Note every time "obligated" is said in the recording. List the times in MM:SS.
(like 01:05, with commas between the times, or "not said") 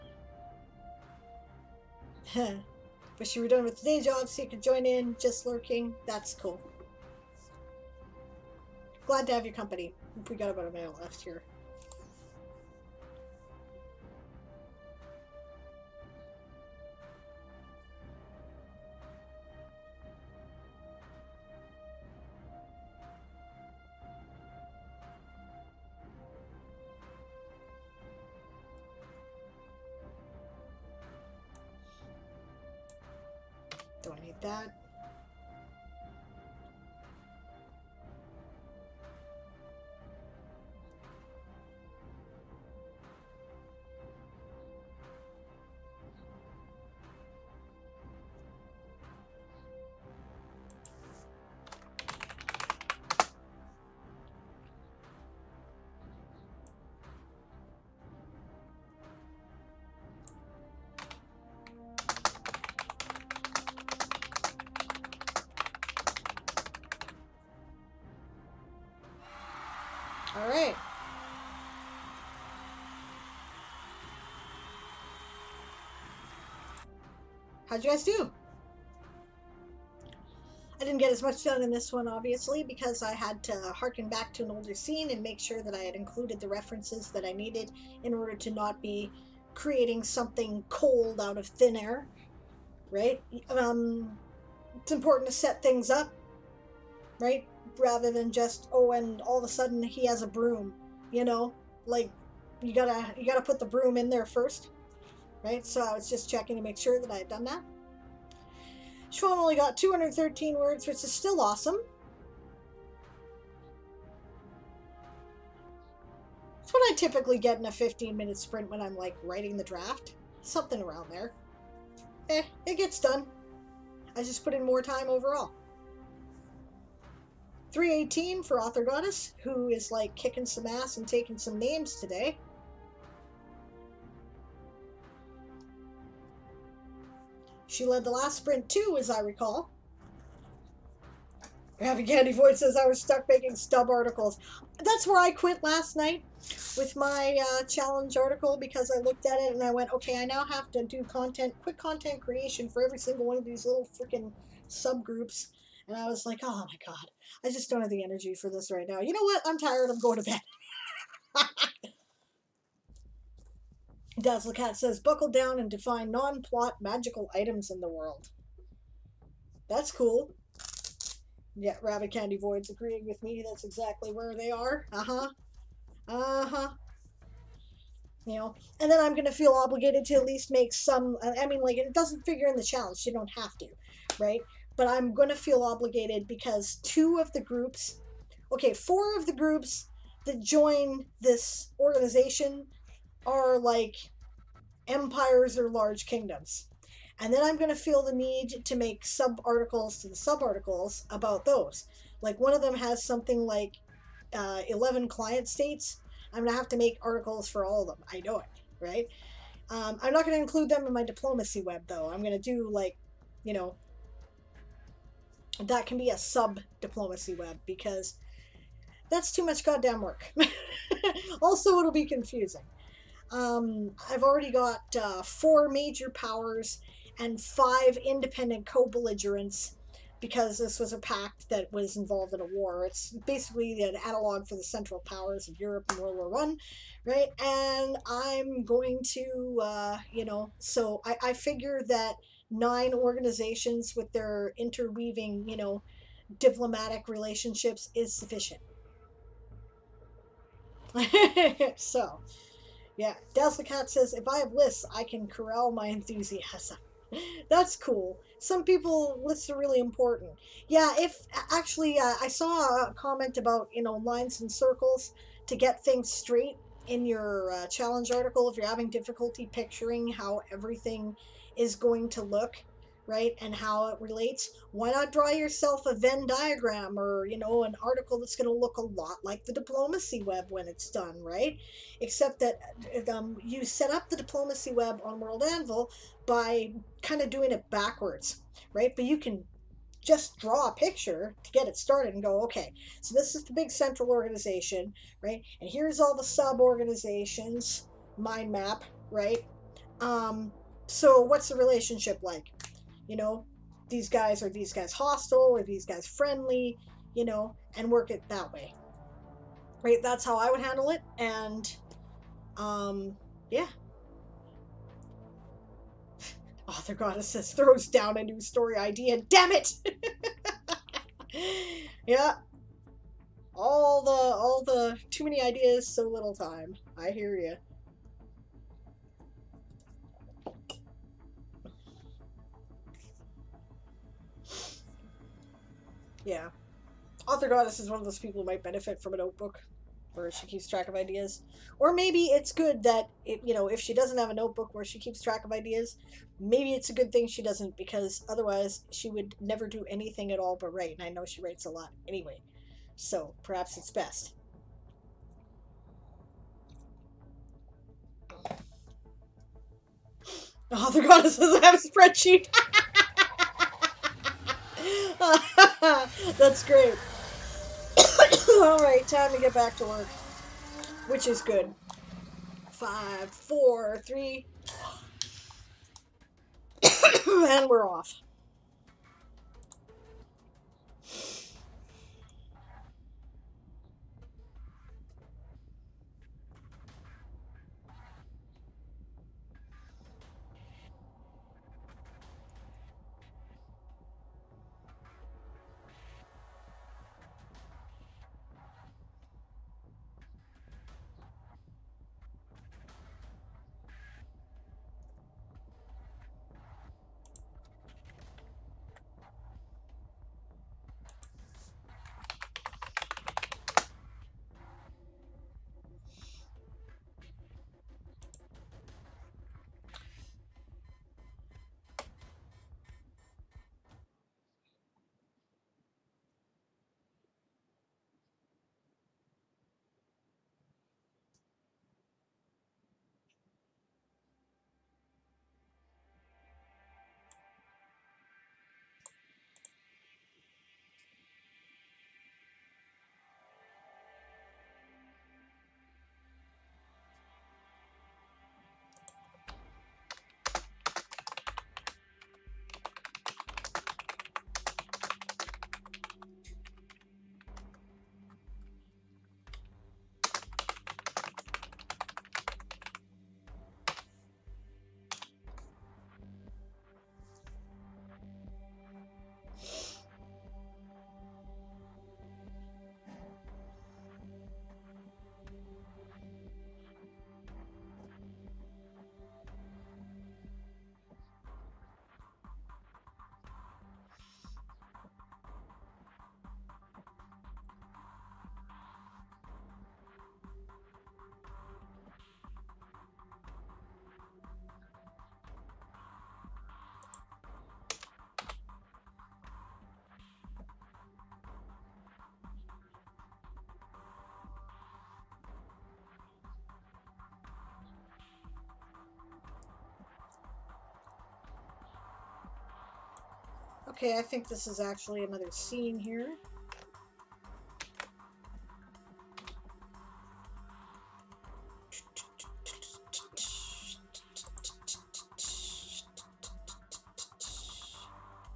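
02:59, 03:05.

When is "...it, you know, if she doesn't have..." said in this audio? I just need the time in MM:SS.
05:43.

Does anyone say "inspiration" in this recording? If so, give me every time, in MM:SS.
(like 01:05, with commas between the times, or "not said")
not said.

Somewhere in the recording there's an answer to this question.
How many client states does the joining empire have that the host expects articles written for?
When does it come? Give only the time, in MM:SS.
03:24.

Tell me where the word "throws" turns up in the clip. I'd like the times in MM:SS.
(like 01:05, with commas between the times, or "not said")
05:17.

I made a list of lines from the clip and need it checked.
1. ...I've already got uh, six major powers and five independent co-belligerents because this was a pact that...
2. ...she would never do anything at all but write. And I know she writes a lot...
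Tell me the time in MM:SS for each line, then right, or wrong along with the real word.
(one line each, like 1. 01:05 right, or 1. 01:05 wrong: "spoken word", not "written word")
1. 03:44 wrong: "four", not "six"
2. 05:48 right.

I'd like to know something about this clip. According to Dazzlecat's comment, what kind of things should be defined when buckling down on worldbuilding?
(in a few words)
non-plot magical items.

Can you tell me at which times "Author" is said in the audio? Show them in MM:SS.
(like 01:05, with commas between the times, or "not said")
02:08, 05:16, 05:37, 06:00.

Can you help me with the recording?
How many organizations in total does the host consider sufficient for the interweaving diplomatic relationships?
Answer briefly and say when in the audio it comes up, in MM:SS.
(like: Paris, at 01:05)
9, at 04:02.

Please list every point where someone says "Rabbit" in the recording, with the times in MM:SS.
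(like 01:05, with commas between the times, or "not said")
02:51.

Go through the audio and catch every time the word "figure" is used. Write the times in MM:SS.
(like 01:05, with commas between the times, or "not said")
03:02, 04:01.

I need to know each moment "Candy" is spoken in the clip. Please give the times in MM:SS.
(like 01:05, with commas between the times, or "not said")
02:22, 02:52.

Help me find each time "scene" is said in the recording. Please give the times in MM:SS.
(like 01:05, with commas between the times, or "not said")
01:24, 08:35.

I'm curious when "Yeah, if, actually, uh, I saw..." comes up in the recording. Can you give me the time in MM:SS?
04:20.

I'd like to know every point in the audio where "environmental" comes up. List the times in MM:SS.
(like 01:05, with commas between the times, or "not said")
not said.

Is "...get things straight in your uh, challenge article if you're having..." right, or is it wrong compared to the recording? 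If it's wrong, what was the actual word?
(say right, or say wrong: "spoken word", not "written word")
right.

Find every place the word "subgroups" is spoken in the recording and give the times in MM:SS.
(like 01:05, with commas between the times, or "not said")
02:34.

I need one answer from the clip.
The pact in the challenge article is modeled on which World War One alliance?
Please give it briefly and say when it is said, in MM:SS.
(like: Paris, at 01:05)
the central powers, at 03:54.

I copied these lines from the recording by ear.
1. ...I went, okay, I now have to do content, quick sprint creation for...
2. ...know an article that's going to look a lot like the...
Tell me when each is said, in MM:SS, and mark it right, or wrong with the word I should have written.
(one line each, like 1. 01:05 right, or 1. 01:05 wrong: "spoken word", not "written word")
1. 02:29 wrong: "content", not "sprint"
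2. 04:37 right.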